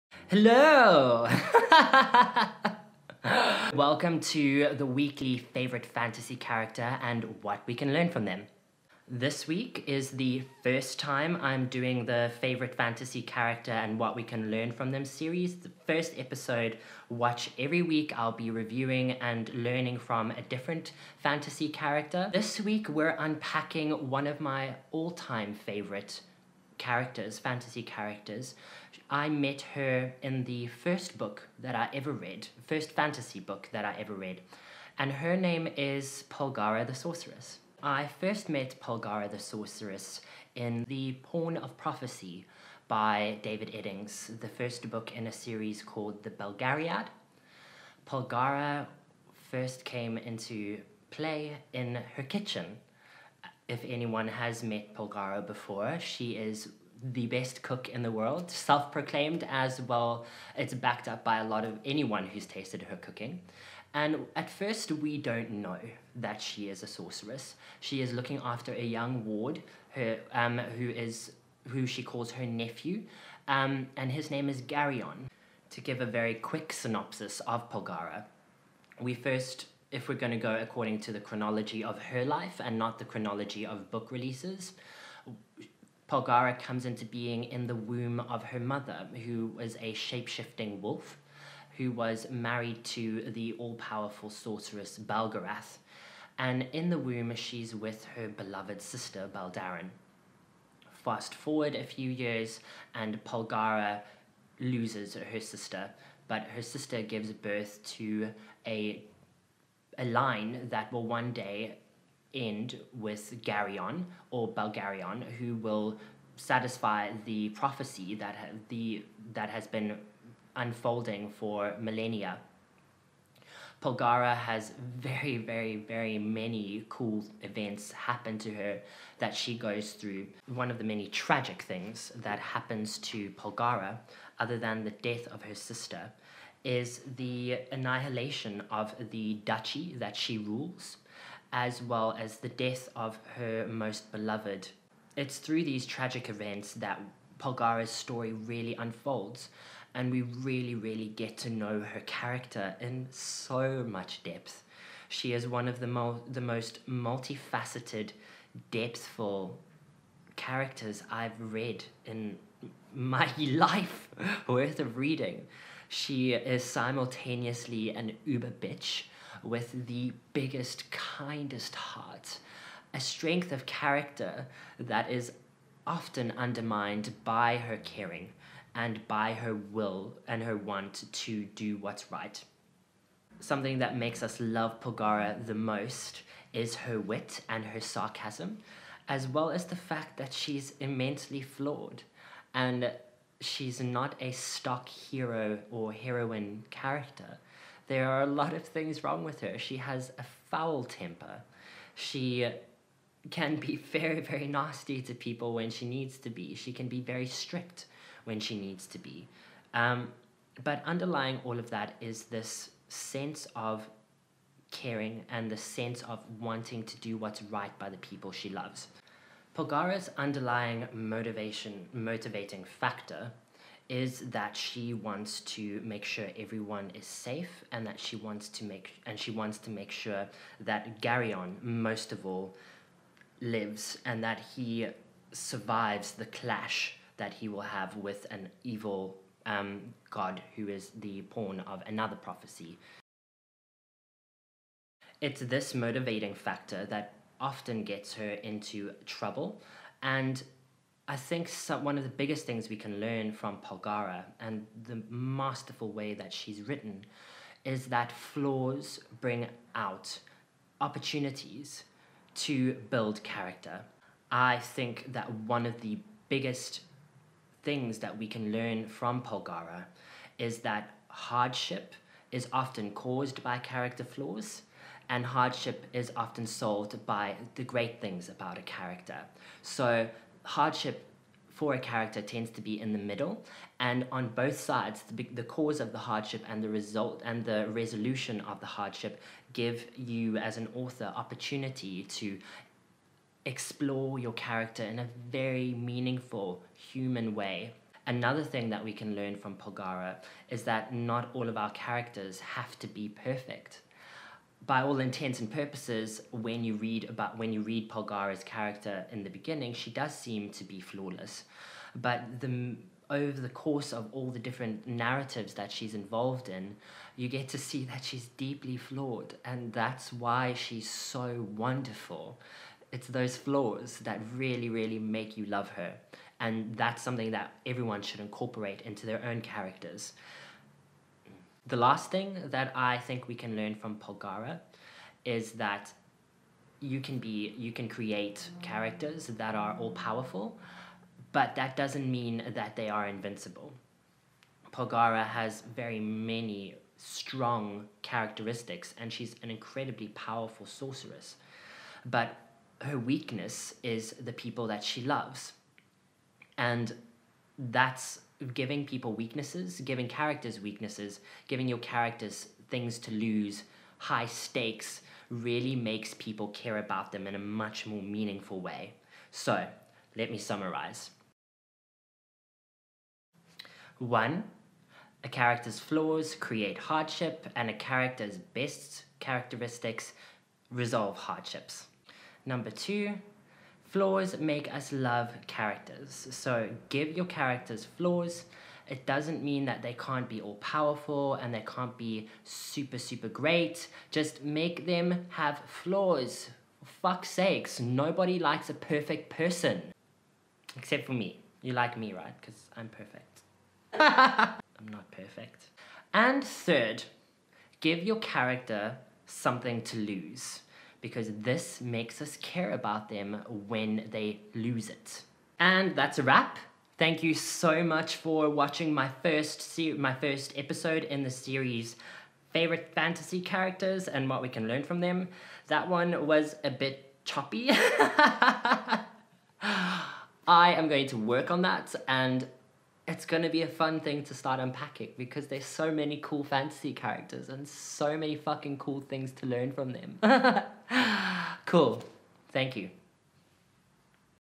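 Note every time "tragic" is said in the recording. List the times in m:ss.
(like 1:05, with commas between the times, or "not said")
2:11, 2:25.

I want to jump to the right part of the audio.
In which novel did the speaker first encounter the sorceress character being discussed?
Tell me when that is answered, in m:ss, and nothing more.
0:40.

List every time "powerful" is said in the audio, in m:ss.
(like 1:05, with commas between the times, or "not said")
1:33, 5:39, 5:50, 6:30.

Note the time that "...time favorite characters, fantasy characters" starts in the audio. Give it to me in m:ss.
0:25.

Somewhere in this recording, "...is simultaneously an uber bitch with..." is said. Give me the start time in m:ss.
2:46.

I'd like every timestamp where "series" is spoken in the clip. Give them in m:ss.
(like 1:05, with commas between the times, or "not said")
0:15, 0:45, 7:01.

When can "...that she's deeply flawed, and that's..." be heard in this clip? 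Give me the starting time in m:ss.
5:17.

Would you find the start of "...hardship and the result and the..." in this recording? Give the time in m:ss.
4:45.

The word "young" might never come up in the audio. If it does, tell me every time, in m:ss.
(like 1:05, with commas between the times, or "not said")
1:08.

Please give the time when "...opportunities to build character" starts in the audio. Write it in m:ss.
4:20.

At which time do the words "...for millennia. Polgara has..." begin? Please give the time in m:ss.
2:01.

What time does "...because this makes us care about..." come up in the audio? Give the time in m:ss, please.
6:51.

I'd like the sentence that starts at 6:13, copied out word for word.
One, a character's flaws create hardship, and a character's best characteristics resolve hardships.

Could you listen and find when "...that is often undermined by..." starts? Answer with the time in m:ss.
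2:54.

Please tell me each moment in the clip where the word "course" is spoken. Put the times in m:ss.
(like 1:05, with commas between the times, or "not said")
5:13.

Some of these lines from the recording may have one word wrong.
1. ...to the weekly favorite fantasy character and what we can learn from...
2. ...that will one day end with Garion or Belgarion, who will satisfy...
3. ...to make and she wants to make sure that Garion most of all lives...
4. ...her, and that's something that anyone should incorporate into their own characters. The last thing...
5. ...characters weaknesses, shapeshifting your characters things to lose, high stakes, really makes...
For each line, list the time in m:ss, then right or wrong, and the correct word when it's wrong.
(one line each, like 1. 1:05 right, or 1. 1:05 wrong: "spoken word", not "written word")
1. 0:04 right
2. 1:50 right
3. 3:48 right
4. 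5:25 wrong: "everyone", not "anyone"
5. 6:00 wrong: "giving", not "shapeshifting".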